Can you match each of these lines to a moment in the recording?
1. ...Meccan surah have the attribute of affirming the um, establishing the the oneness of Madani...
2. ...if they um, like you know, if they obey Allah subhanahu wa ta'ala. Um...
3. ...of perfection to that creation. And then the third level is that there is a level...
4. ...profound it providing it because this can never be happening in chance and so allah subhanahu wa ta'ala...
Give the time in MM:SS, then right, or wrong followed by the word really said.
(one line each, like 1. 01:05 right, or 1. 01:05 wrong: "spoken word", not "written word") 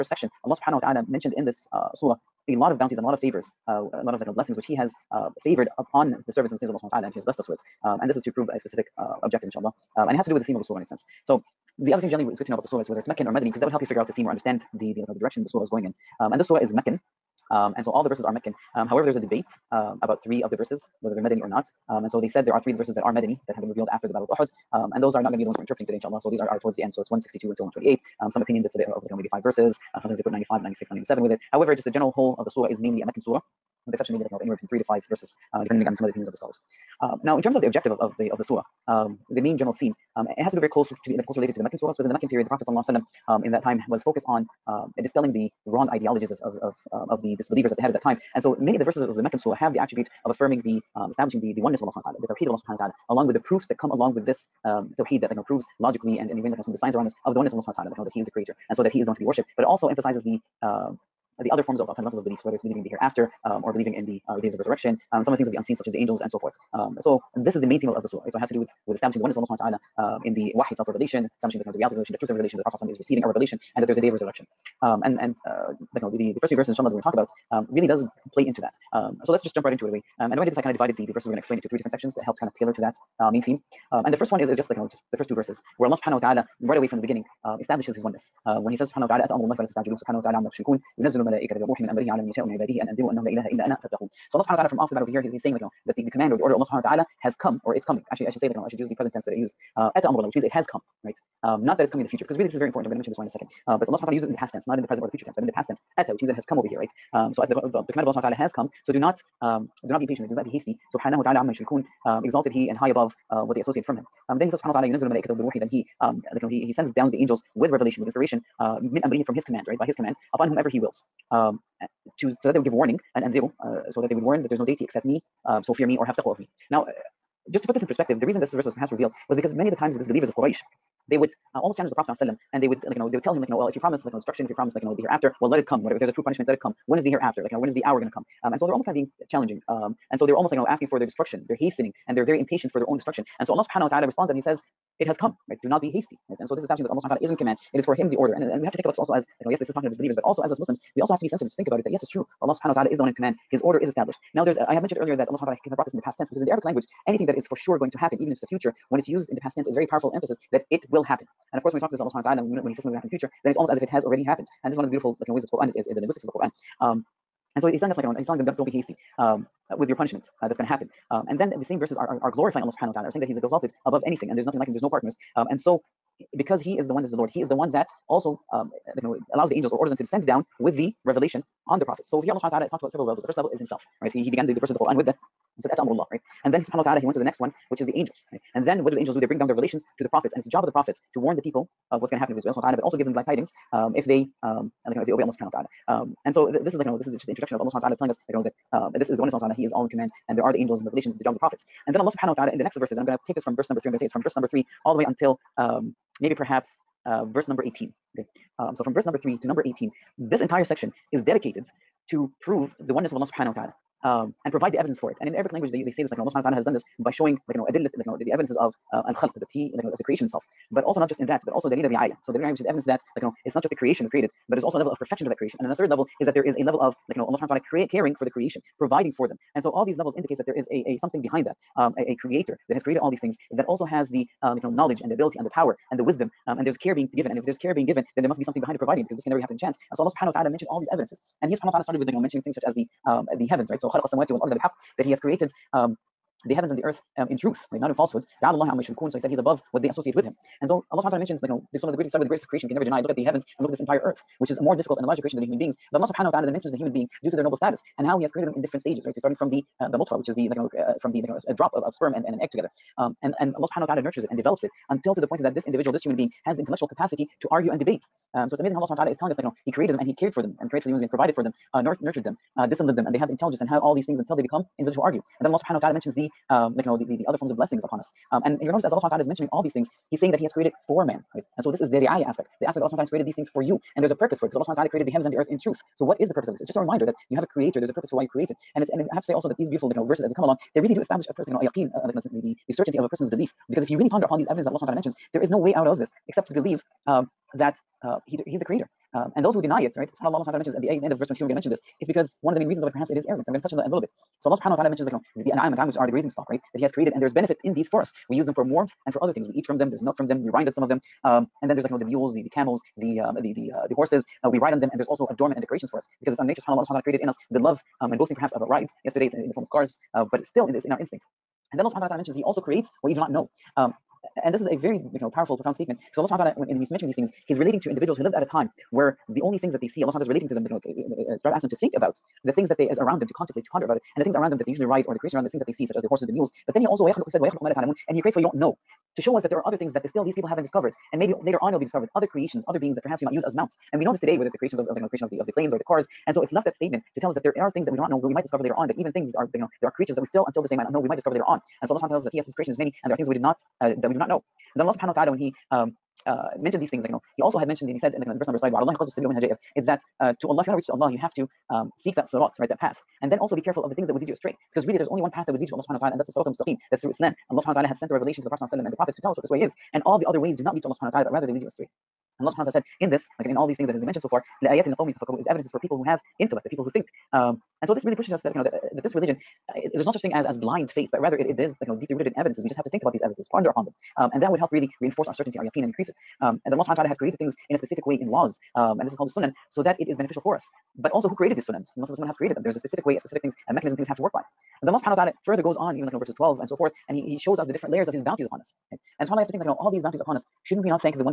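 1. 00:49 wrong: "Allah", not "Madani"
2. 03:13 right
3. 03:44 right
4. 03:58 wrong: "behind", not "profound".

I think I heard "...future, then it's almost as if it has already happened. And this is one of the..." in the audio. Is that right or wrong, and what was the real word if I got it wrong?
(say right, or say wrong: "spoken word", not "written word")
right.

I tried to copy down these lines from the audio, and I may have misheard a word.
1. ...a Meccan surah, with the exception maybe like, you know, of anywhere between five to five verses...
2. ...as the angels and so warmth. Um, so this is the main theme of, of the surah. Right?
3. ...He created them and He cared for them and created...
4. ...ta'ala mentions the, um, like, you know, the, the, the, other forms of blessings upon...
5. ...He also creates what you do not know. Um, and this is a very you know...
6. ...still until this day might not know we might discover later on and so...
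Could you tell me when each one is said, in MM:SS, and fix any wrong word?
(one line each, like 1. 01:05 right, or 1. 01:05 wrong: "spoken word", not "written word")
1. 00:33 wrong: "three", not "five"
2. 01:05 wrong: "forth", not "warmth"
3. 04:29 right
4. 04:35 right
5. 05:22 right
6. 05:50 right.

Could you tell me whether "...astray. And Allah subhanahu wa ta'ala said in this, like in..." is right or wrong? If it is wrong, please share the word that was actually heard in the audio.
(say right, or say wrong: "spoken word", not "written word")
right.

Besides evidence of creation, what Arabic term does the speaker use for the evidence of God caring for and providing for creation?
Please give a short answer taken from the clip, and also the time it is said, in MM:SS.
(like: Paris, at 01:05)
dalil al-ri'ayah, at 03:41.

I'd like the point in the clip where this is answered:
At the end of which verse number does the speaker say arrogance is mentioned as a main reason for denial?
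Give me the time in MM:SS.
05:01.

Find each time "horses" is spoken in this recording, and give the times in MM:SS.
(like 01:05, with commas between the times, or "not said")
05:13, 05:36.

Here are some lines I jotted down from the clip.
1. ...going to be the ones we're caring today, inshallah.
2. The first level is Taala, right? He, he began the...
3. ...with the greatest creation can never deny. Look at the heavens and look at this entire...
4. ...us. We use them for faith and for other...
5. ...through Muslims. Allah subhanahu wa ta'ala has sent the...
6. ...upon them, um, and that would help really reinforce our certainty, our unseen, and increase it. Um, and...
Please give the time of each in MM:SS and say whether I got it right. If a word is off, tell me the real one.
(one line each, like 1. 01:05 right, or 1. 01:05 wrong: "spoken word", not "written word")
1. 00:25 wrong: "interpreting", not "caring"
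2. 03:03 wrong: "Himself", not "Taala"
3. 04:12 right
4. 05:08 wrong: "warmth", not "faith"
5. 06:07 wrong: "Islam", not "Muslims"
6. 06:23 wrong: "yaqeen", not "unseen".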